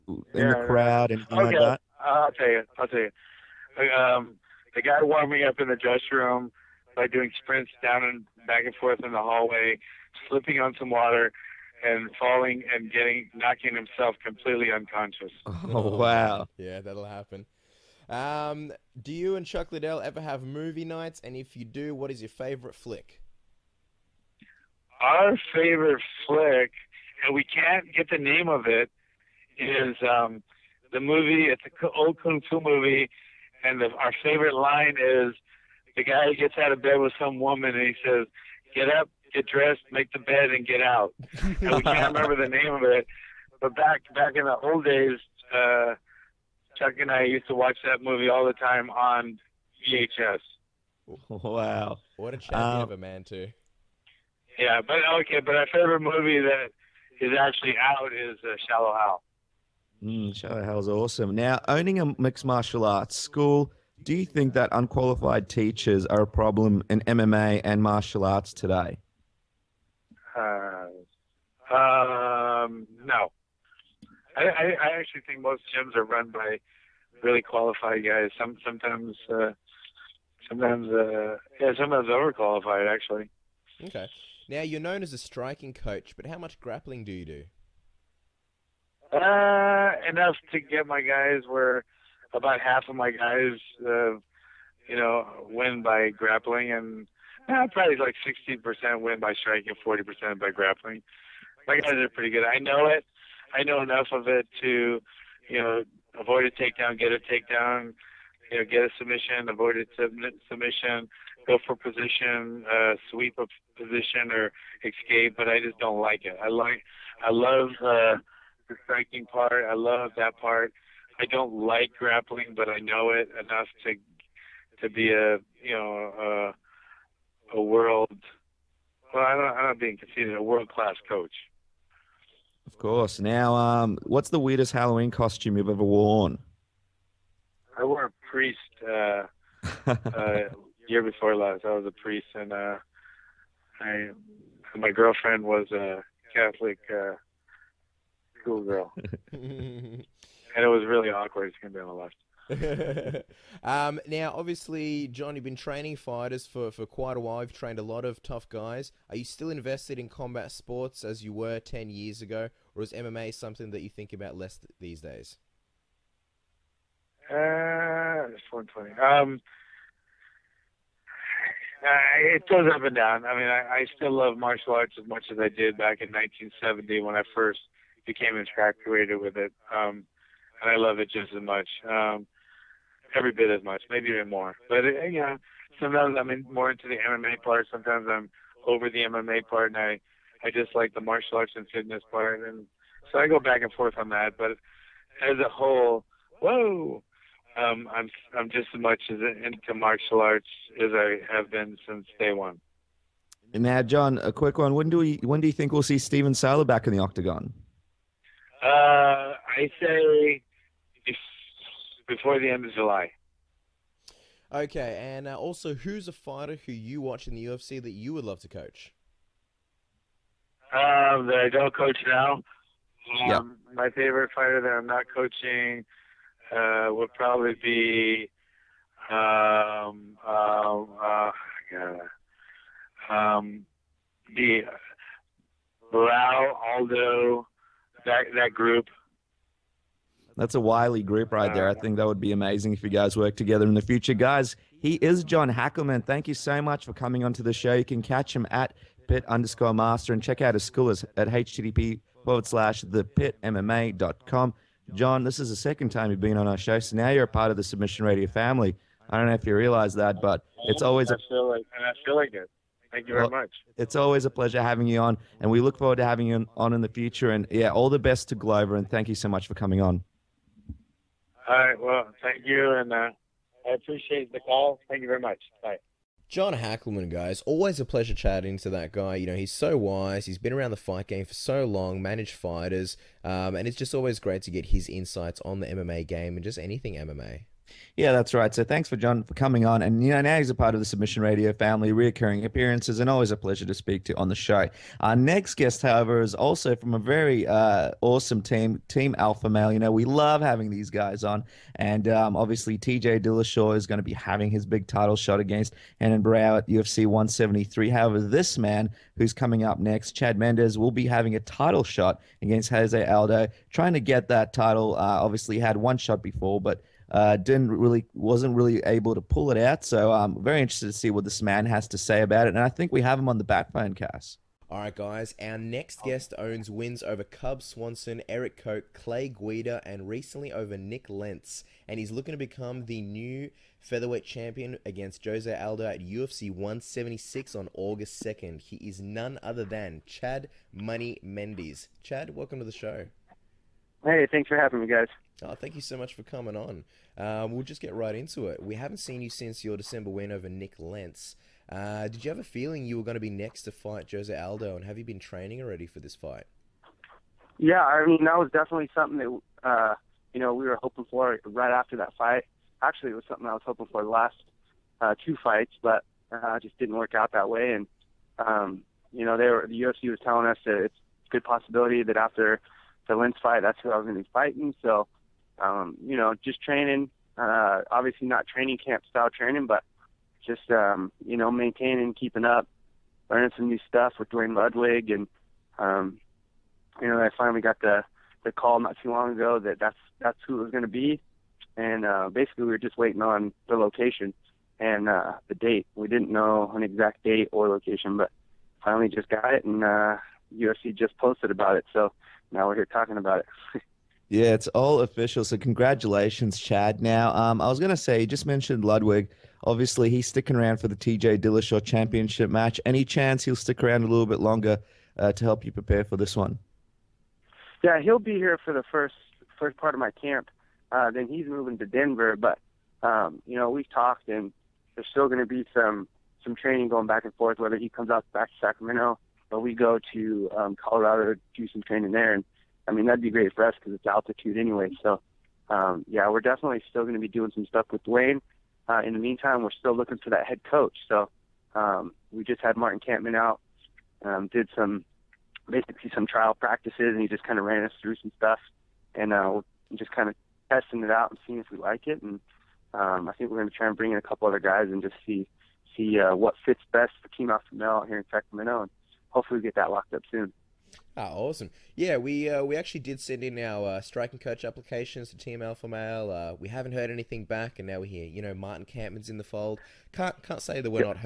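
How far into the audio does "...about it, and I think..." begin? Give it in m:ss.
5:22.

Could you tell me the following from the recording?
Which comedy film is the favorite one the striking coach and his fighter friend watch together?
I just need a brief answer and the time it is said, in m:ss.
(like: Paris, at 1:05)
Shallow Hal, at 0:58.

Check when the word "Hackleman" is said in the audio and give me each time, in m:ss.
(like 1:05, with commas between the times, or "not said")
4:05, 4:36.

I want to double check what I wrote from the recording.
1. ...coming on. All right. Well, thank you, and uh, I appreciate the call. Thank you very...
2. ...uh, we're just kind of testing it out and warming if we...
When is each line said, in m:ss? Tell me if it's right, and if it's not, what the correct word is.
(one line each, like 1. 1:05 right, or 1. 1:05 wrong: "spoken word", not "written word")
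1. 4:29 right
2. 7:29 wrong: "seeing", not "warming".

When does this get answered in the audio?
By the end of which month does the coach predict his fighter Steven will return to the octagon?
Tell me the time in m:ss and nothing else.
3:32.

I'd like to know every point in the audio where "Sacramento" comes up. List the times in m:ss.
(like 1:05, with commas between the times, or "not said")
7:08, 7:38.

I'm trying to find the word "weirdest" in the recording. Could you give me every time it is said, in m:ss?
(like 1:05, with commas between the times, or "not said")
2:14.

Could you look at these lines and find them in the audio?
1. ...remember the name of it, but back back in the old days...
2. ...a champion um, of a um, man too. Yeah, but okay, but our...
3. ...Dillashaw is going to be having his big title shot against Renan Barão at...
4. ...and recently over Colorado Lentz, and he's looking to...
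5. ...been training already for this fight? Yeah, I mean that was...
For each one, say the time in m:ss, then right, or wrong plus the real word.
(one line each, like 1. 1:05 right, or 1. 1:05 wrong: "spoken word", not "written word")
1. 0:42 right
2. 0:52 right
3. 5:03 right
4. 5:29 wrong: "Nik", not "Colorado"
5. 5:55 right.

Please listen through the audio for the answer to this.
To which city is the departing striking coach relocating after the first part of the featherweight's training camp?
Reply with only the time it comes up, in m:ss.
7:01.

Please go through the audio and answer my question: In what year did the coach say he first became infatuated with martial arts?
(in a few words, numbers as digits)
1970.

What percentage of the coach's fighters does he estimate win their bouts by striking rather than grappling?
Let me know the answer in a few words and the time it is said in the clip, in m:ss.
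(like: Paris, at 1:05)
60%, at 1:38.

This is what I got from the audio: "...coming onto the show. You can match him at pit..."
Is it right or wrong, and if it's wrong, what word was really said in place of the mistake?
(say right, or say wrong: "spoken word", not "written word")
wrong: "catch", not "match".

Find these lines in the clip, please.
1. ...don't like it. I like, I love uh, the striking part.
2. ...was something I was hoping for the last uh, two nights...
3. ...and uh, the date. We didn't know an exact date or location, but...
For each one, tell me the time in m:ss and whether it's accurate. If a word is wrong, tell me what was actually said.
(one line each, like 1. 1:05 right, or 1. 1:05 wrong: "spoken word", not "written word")
1. 1:55 right
2. 6:03 wrong: "fights", not "nights"
3. 6:34 right.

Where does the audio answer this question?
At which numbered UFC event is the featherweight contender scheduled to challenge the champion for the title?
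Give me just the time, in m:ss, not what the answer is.
5:35.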